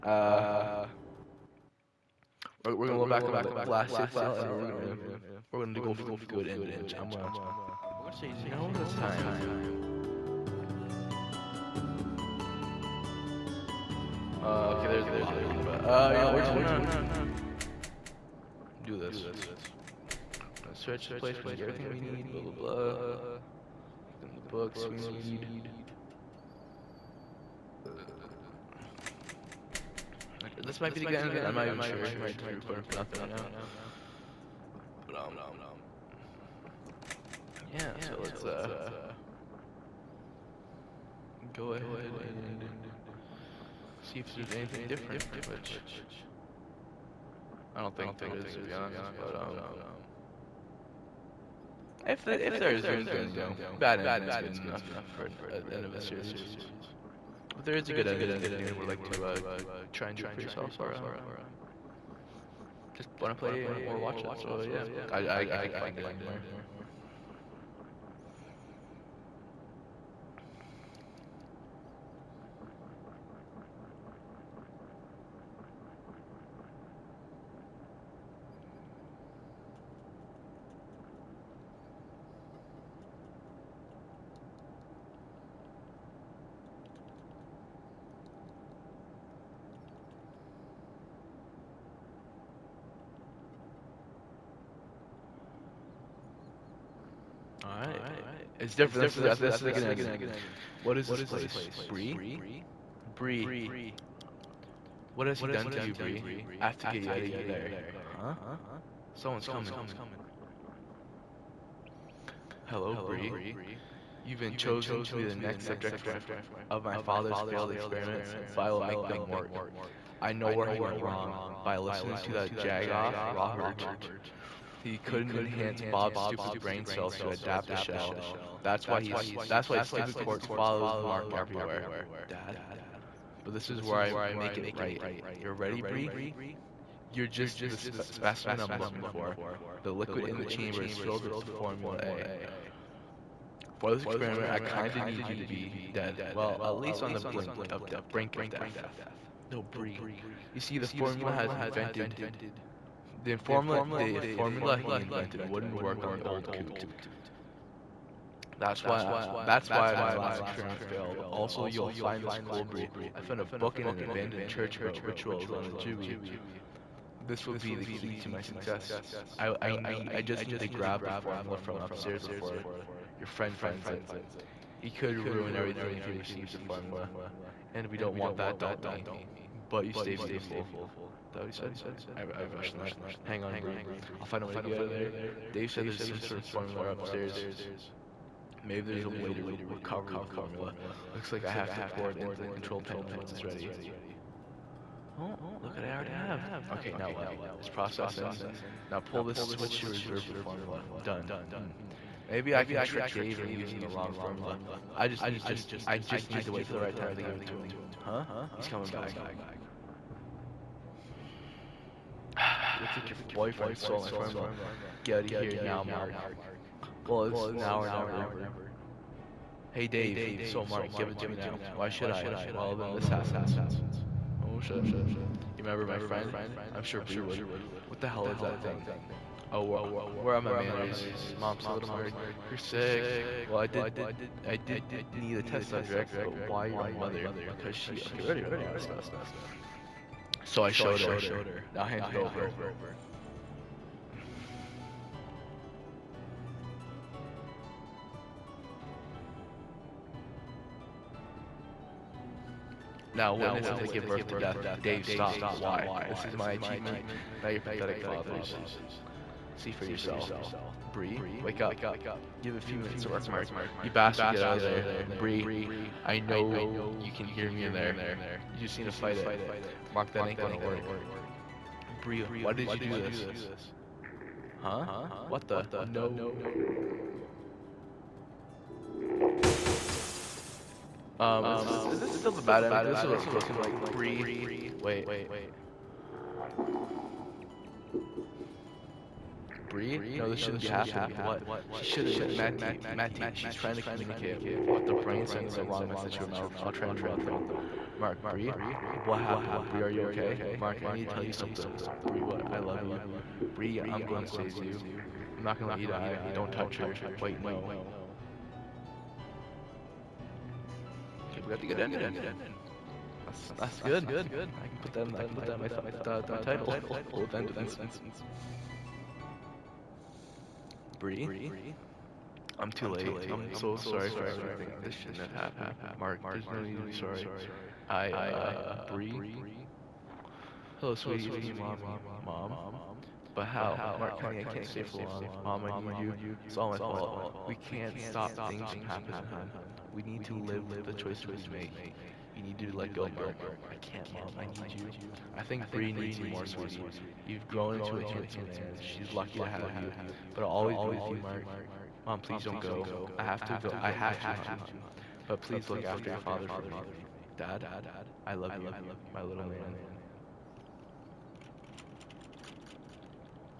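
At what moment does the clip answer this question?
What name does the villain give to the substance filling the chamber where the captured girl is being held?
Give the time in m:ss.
2:21.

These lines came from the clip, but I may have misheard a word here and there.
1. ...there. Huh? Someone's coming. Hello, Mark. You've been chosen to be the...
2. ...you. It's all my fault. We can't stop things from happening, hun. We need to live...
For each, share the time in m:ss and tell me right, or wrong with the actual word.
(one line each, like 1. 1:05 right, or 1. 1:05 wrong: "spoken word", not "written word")
1. 1:47 wrong: "Bree", not "Mark"
2. 5:35 right.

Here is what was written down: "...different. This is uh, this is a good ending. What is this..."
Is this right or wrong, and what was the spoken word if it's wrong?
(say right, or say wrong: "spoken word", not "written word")
right.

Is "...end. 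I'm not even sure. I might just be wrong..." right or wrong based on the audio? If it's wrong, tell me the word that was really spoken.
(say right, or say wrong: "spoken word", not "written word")
wrong: "recording", not "wrong".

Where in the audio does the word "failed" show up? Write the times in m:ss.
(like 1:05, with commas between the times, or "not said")
1:57, 2:40.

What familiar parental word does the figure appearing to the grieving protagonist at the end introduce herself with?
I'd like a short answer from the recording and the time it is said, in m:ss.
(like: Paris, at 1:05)
Mommy, at 5:31.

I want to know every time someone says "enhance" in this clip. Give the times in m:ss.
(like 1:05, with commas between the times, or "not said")
2:05.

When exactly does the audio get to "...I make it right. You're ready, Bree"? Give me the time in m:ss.
2:14.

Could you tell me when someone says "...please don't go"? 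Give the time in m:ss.
5:52.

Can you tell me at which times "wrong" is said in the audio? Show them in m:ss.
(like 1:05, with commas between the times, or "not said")
2:00, 3:23, 4:55.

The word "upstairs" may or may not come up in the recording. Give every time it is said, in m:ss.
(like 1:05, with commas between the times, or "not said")
2:51, 3:06.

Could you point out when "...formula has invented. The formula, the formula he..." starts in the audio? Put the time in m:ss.
2:30.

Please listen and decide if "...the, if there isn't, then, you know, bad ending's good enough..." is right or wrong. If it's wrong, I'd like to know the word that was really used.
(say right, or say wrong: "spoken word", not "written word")
right.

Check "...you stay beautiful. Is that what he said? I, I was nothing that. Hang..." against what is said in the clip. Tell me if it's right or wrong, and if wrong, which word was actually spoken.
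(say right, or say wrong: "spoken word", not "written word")
wrong: "rushing", not "nothing".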